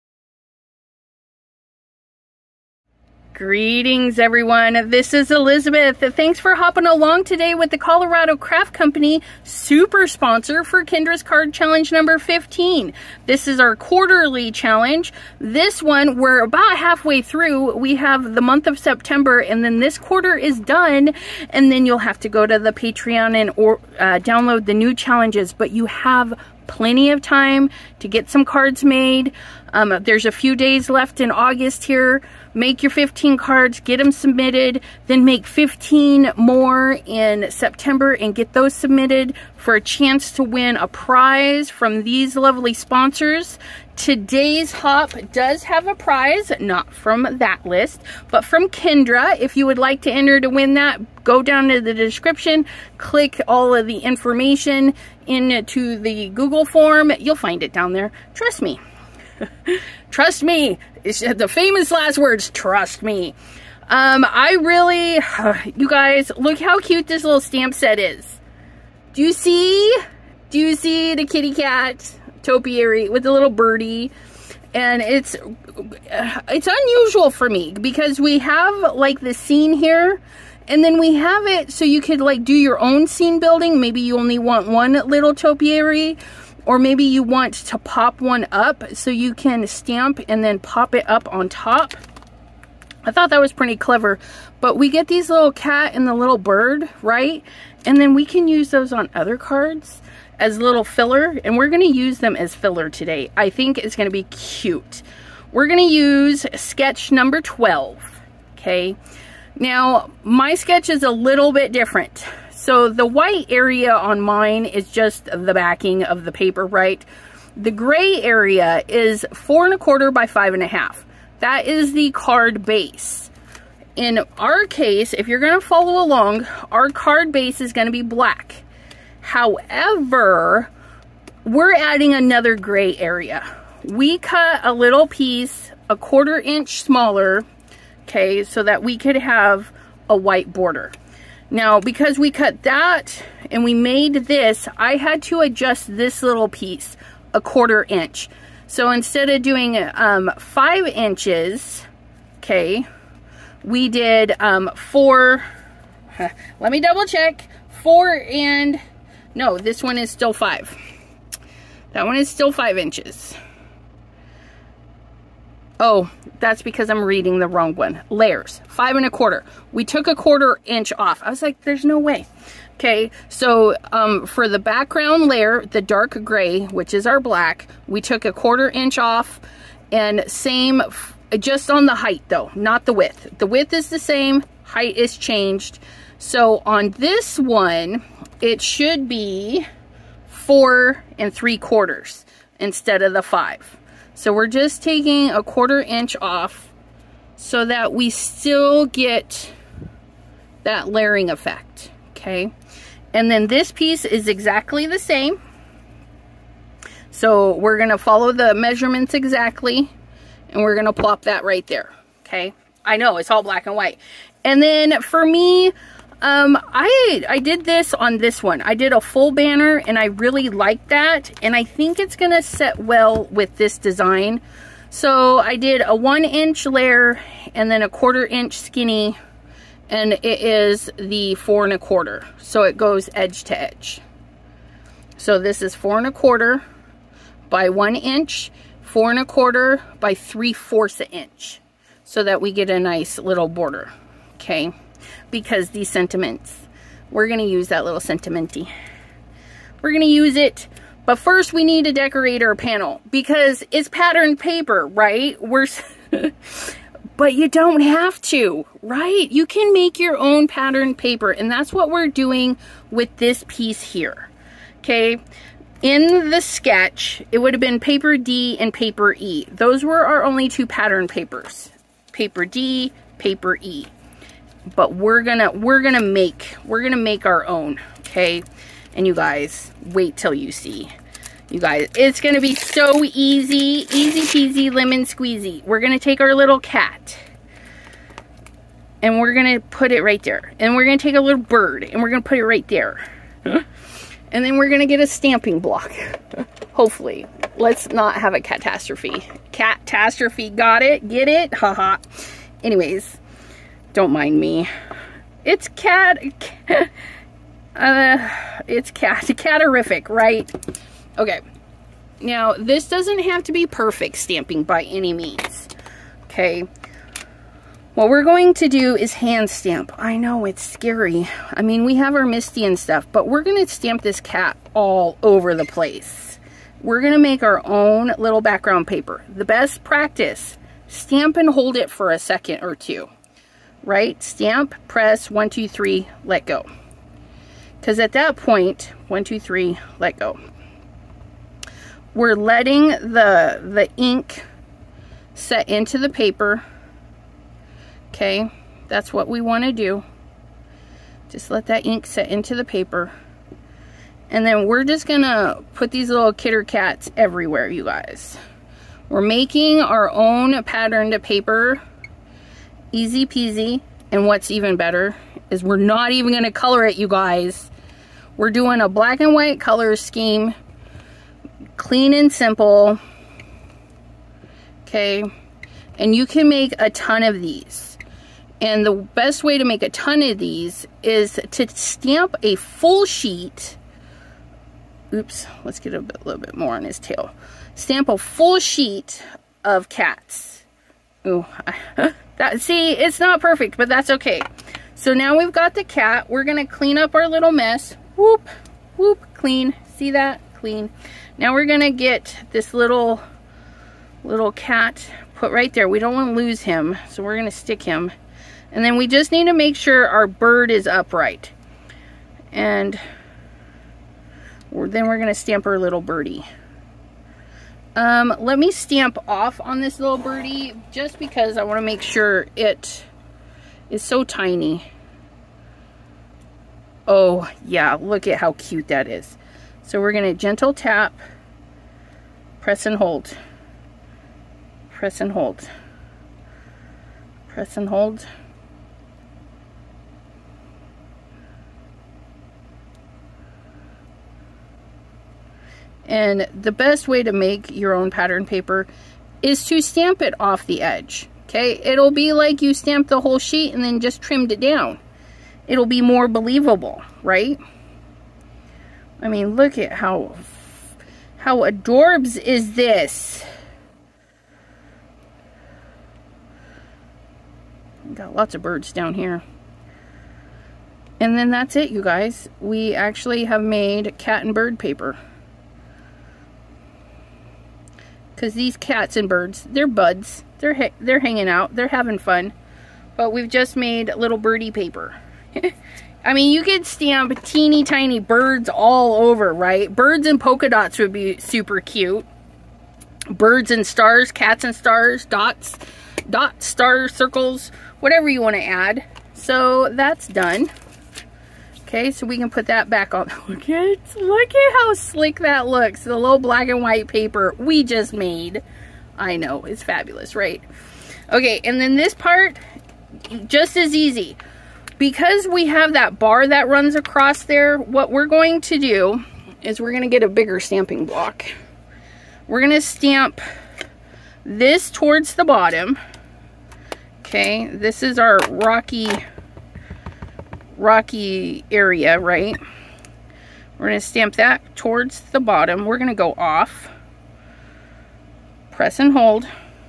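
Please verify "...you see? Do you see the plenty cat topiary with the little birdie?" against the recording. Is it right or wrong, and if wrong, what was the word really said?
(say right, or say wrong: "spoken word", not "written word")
wrong: "kitty", not "plenty".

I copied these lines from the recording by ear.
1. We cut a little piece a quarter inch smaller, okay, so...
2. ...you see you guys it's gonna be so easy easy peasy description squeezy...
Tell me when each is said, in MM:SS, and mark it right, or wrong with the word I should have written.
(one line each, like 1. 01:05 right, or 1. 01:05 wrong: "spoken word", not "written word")
1. 02:13 right
2. 04:40 wrong: "lemon", not "description".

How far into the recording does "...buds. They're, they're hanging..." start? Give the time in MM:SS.
07:59.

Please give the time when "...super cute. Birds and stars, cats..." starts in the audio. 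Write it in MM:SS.
08:11.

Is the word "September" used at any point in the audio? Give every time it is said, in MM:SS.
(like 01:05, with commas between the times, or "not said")
00:18, 00:37.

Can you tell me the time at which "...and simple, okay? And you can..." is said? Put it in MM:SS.
06:12.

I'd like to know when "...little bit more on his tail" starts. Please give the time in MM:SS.
06:26.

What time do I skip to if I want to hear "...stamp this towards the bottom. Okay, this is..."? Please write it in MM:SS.
08:42.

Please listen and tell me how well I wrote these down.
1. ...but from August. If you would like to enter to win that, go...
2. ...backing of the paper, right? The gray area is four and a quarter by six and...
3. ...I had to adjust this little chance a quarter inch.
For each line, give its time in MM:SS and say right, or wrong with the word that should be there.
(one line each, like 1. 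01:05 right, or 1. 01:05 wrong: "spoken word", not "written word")
1. 00:48 wrong: "Kendra", not "August"
2. 01:55 wrong: "five", not "six"
3. 02:24 wrong: "piece", not "chance".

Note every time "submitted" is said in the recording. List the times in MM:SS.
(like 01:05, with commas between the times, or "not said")
00:34, 00:38.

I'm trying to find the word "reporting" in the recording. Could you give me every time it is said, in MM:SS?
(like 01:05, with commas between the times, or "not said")
not said.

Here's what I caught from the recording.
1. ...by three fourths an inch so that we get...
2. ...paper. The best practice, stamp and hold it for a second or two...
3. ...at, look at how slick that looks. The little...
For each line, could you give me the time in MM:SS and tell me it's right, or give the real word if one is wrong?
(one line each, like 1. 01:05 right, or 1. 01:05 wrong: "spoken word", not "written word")
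1. 03:59 right
2. 05:28 right
3. 08:23 right.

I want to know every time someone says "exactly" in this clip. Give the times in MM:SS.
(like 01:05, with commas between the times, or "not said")
03:24, 03:29.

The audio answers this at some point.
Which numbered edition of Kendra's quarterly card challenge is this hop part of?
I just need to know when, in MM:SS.
00:11.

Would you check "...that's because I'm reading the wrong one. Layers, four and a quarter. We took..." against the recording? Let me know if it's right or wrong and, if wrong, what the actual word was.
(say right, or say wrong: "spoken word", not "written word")
wrong: "five", not "four".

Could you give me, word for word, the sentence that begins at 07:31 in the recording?
Okay, it'll be like you stamped the whole sheet and then just trimmed it down.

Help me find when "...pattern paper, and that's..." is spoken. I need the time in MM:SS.
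04:20.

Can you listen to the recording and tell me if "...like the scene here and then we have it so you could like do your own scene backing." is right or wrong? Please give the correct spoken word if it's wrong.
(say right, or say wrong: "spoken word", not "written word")
wrong: "building", not "backing".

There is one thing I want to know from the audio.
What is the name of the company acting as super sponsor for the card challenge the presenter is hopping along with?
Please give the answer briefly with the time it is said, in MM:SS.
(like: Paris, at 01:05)
Colorado Craft Company, at 00:07.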